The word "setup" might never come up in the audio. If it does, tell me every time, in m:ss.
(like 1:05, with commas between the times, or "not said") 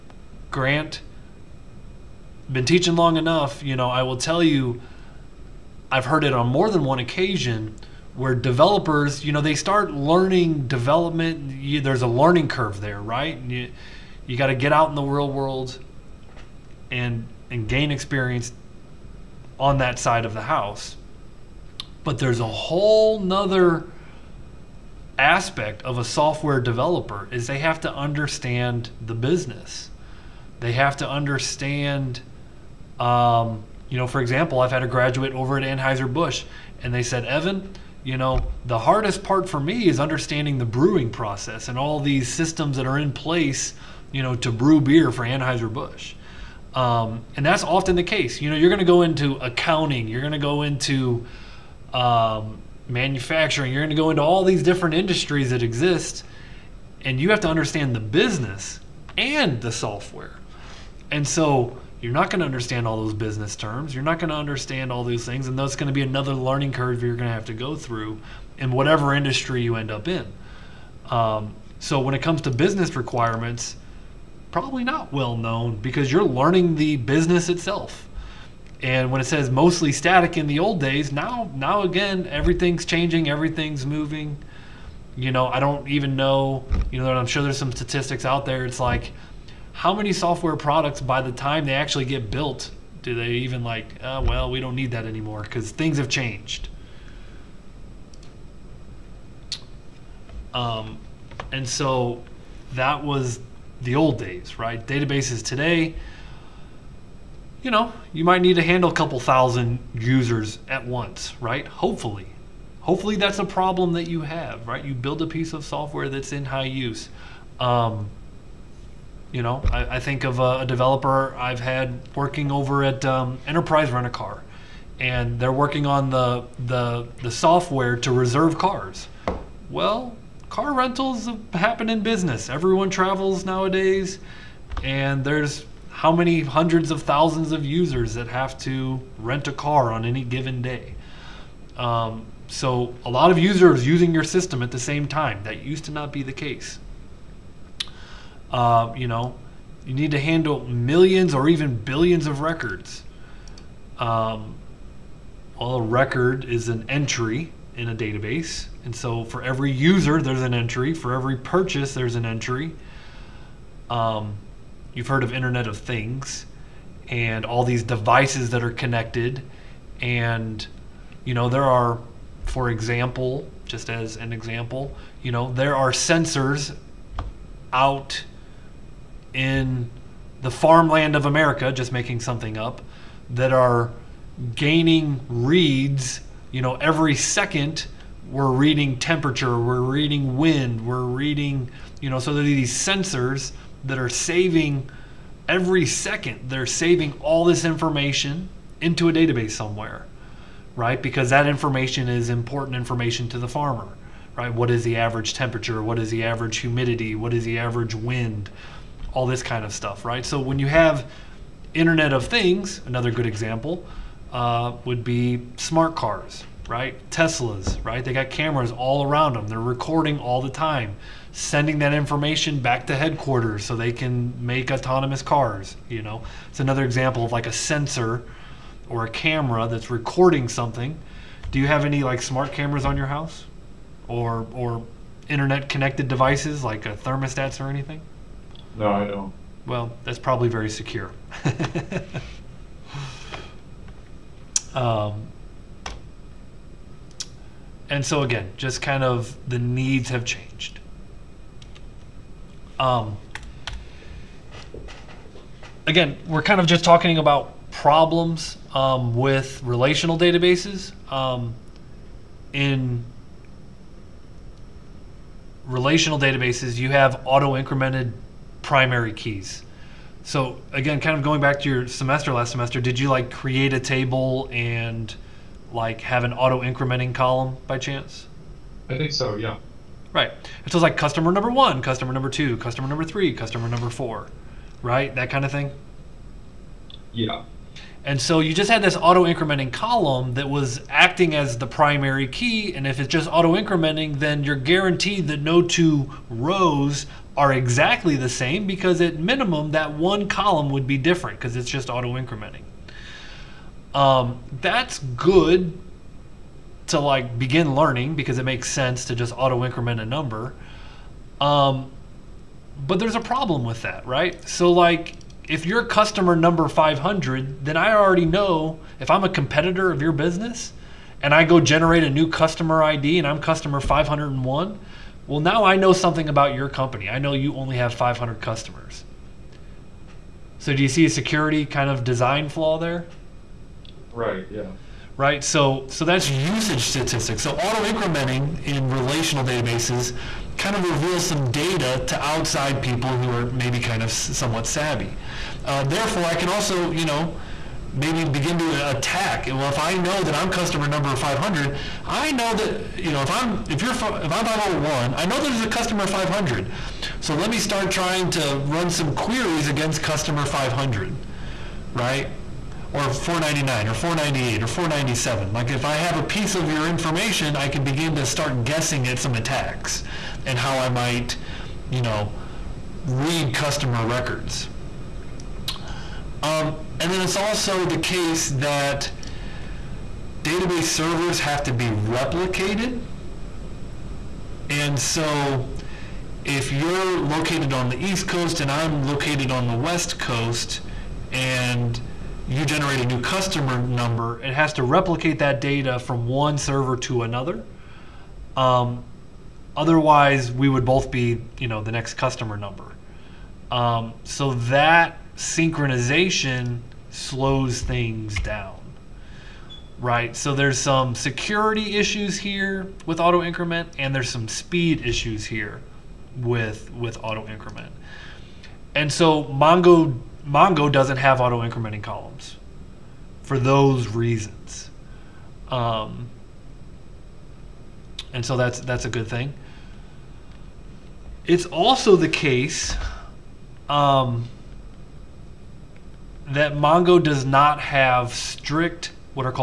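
not said.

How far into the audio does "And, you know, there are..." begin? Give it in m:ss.
2:49.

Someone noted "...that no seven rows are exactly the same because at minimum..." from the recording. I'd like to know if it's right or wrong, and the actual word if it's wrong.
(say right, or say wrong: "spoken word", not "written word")
wrong: "two", not "seven".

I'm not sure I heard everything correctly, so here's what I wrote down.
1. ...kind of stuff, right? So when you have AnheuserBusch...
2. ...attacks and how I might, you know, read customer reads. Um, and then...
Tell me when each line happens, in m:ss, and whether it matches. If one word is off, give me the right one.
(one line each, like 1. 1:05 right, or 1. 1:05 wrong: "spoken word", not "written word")
1. 3:29 wrong: "Internet", not "AnheuserBusch"
2. 6:09 wrong: "records", not "reads".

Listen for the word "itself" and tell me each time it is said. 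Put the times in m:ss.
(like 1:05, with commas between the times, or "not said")
1:17.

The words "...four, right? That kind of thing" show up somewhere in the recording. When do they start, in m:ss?
4:43.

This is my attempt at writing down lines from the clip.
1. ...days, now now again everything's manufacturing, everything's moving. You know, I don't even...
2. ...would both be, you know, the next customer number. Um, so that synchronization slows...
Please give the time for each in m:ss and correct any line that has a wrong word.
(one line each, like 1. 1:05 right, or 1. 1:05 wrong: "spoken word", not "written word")
1. 1:20 wrong: "changing", not "manufacturing"
2. 6:40 right.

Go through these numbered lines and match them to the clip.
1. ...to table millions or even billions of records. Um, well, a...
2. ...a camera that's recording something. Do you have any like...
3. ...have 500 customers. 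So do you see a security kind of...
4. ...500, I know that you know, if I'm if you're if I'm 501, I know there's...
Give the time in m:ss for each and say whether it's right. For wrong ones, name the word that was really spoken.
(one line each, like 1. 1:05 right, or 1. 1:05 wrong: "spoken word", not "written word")
1. 2:30 wrong: "handle", not "table"
2. 3:49 right
3. 5:27 right
4. 5:51 right.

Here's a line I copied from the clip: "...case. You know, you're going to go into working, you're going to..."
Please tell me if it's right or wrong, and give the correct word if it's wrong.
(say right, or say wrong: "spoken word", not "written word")
wrong: "accounting", not "working".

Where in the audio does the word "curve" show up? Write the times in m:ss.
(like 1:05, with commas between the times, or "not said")
0:12, 1:06.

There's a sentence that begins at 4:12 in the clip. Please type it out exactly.
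Um, again, we're kind of just talking about problems um, with relational databases.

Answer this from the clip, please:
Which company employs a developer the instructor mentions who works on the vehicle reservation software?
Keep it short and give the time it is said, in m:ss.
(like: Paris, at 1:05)
Enterprise Rent a Car, at 2:03.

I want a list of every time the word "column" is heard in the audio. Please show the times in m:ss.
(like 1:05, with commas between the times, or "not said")
4:37, 4:49, 5:00, 7:02.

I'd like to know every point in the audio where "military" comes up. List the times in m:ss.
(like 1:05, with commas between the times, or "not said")
not said.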